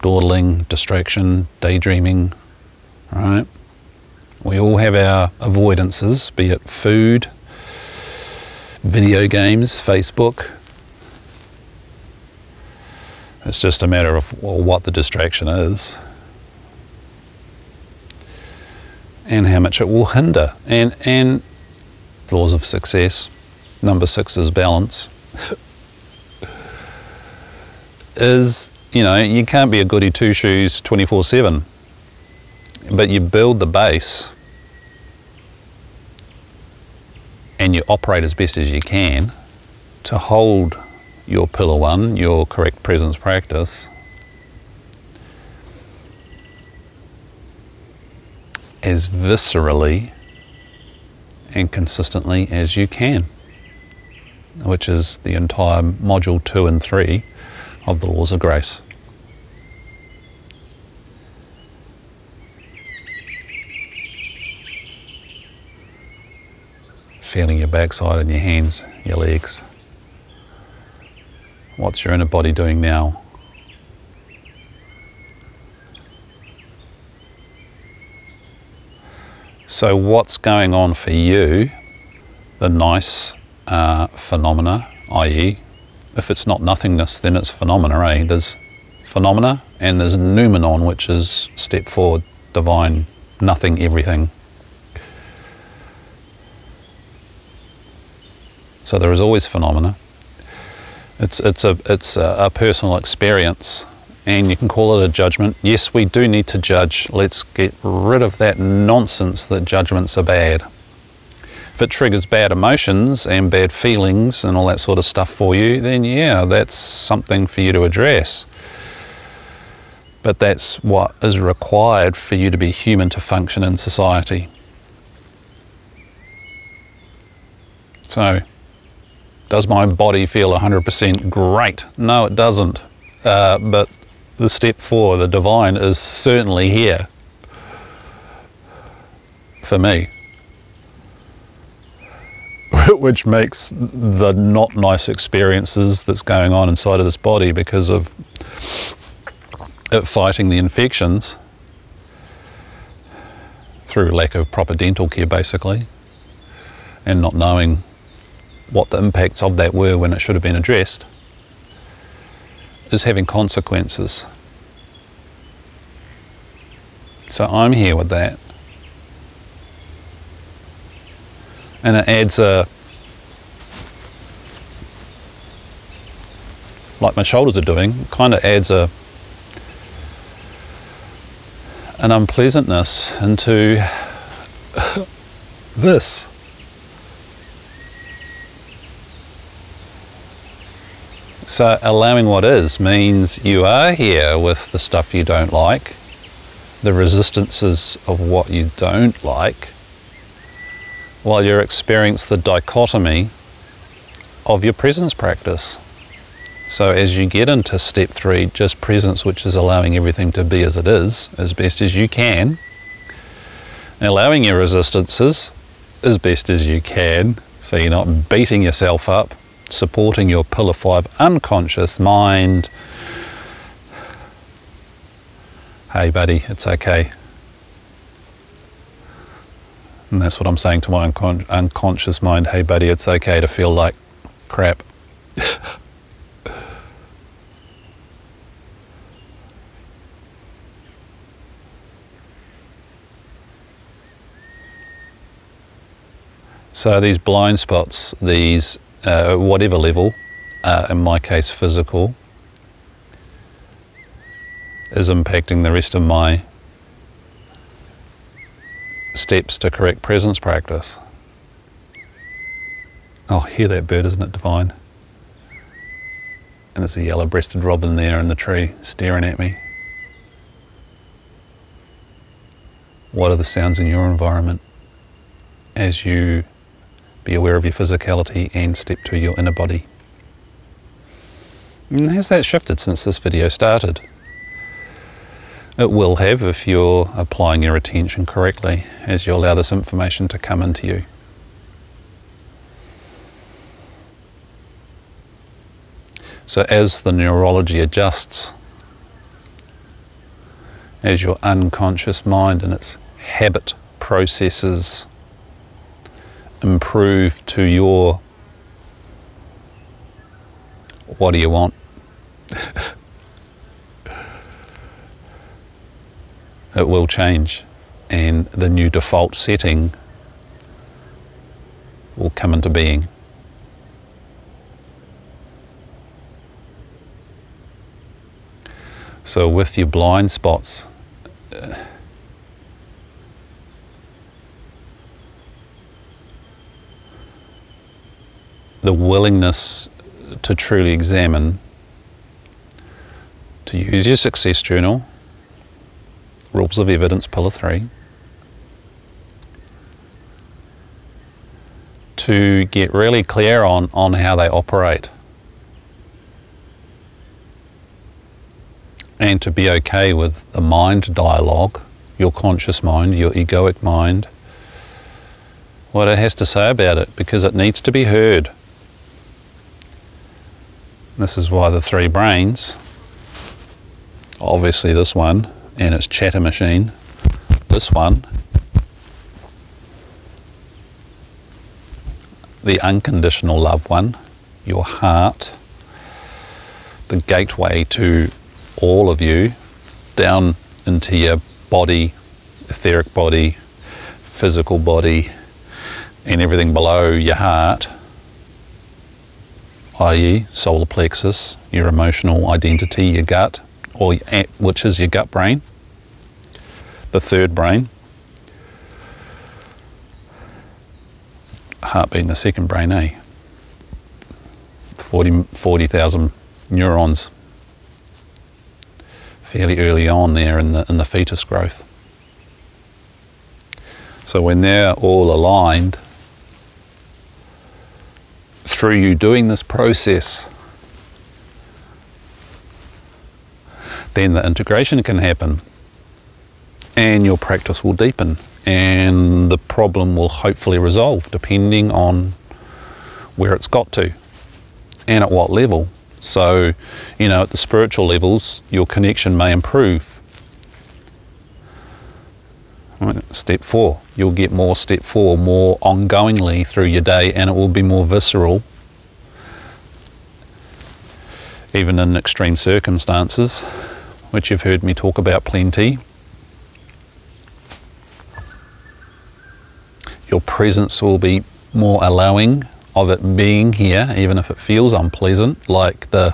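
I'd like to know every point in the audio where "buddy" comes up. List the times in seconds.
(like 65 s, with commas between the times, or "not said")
226 s, 232 s.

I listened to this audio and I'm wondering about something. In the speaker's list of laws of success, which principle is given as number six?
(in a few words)
Balance.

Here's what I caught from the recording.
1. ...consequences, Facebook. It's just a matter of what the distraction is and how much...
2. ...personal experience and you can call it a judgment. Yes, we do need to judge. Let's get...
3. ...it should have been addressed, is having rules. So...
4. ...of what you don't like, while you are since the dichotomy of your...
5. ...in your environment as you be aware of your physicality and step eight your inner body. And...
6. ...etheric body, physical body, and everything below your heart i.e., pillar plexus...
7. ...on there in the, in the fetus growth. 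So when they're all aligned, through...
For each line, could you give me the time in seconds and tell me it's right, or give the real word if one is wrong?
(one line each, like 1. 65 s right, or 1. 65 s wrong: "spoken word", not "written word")
1. 9 s wrong: "games", not "consequences"
2. 102 s right
3. 160 s wrong: "consequences", not "rules"
4. 198 s wrong: "experience", not "since"
5. 273 s wrong: "two", not "eight"
6. 392 s wrong: "solar", not "pillar"
7. 420 s right.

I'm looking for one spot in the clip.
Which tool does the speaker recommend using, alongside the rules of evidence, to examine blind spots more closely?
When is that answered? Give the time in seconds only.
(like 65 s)
344 s.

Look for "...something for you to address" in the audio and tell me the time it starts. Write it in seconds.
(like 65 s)
116 s.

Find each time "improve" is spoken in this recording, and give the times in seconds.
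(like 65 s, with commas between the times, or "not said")
306 s, 449 s.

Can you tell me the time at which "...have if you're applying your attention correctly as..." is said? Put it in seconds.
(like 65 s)
286 s.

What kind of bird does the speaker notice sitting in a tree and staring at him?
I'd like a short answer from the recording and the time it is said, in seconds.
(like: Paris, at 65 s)
Yellow breasted robin, at 267 s.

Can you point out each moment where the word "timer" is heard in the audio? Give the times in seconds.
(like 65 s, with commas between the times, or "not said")
not said.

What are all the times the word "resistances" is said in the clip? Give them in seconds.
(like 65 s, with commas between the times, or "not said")
196 s, 214 s.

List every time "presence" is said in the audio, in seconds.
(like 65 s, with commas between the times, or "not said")
42 s, 204 s, 208 s, 260 s, 470 s.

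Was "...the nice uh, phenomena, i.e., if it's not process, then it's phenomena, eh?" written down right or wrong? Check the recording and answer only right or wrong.
wrong.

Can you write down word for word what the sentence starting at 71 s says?
What's your inner body doing now?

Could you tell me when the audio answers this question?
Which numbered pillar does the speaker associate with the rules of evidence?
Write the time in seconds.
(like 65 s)
347 s.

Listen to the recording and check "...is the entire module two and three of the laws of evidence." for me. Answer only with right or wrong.
wrong.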